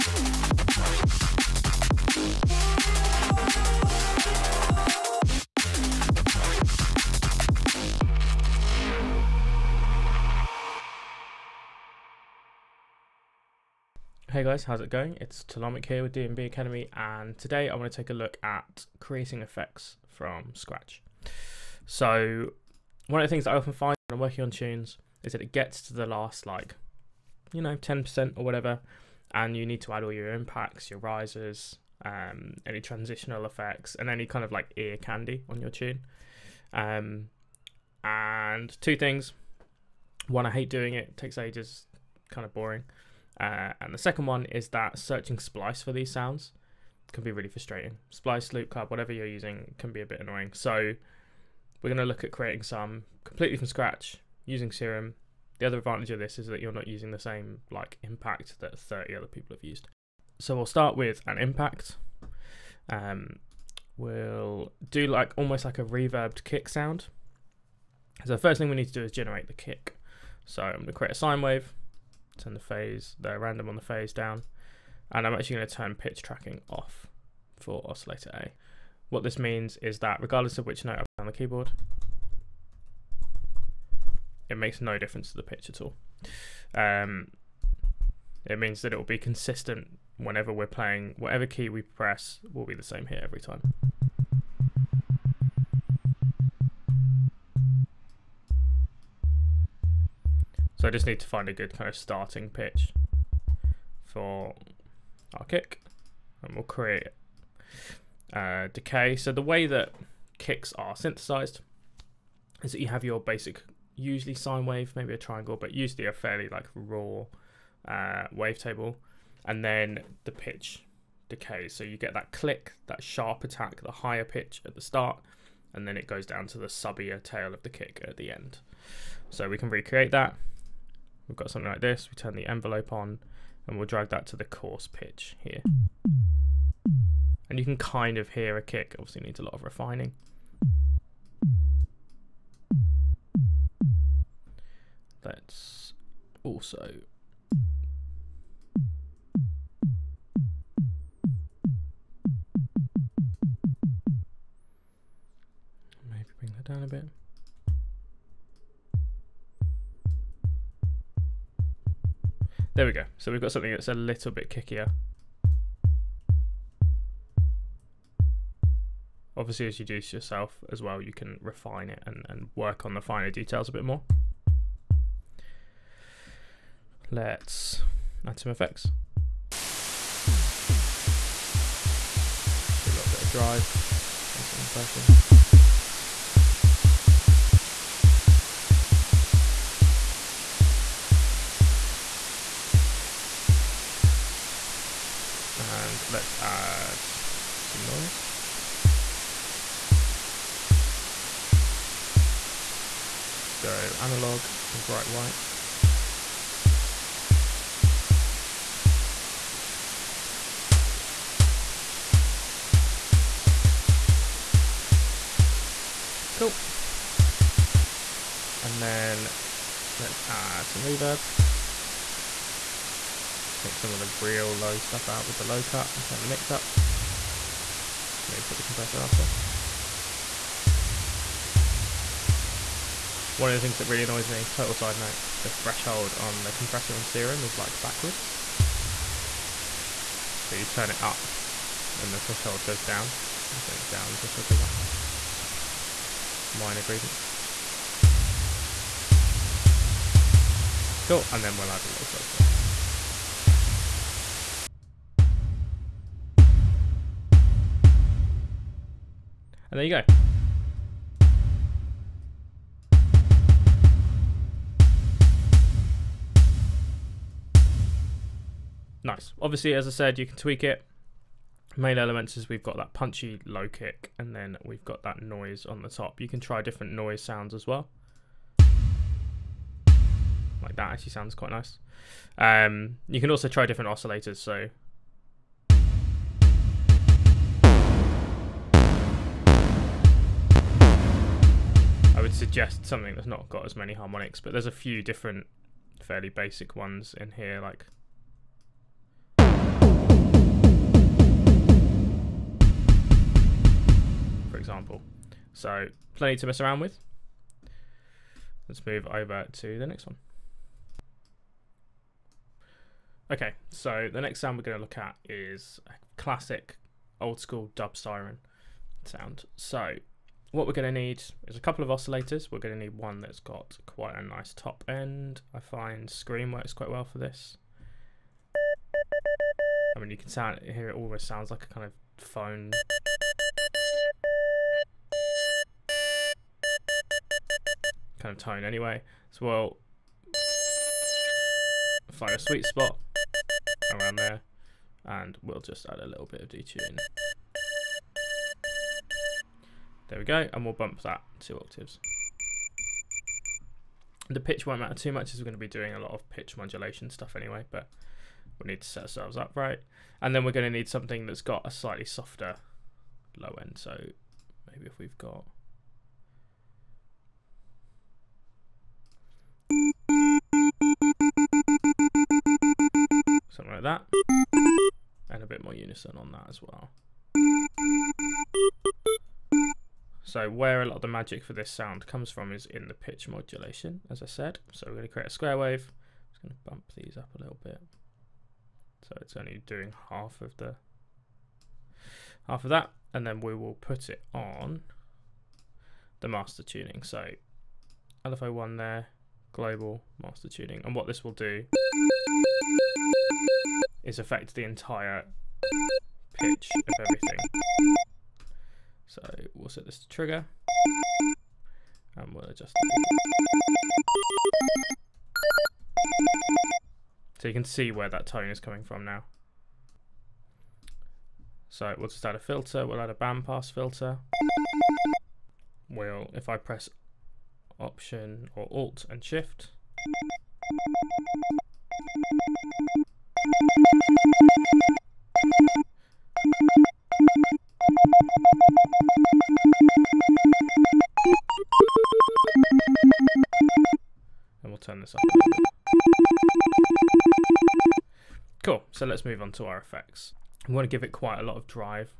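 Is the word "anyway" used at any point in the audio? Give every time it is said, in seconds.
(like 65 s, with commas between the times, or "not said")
338 s, 357 s.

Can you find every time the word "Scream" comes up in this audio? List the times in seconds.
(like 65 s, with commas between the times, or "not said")
326 s.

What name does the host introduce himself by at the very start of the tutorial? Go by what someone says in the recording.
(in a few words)
Telomic.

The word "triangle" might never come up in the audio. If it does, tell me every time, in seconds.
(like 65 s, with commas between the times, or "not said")
115 s.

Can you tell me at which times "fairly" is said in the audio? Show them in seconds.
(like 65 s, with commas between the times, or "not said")
116 s, 296 s.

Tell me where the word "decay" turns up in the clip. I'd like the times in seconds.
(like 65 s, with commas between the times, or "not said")
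108 s, 121 s.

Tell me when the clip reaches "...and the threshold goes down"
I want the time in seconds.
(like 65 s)
241 s.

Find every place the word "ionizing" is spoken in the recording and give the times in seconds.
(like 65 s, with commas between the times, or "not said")
not said.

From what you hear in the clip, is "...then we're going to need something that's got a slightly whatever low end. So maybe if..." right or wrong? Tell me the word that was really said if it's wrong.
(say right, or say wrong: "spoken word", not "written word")
wrong: "softer", not "whatever".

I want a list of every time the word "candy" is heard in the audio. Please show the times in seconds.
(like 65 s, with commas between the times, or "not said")
34 s.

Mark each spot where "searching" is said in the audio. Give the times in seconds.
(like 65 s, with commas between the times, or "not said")
44 s.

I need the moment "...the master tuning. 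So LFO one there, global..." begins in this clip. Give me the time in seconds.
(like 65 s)
396 s.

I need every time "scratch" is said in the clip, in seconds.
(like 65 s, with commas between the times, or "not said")
20 s, 53 s.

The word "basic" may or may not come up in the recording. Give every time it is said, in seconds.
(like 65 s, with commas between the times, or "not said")
113 s, 296 s.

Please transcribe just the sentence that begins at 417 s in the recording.
So you can see where that tone is coming from now.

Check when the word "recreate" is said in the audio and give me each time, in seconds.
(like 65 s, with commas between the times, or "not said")
129 s.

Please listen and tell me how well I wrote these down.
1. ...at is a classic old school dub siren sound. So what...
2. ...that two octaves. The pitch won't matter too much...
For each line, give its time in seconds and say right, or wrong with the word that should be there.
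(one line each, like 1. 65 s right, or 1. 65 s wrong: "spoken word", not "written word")
1. 314 s right
2. 351 s right.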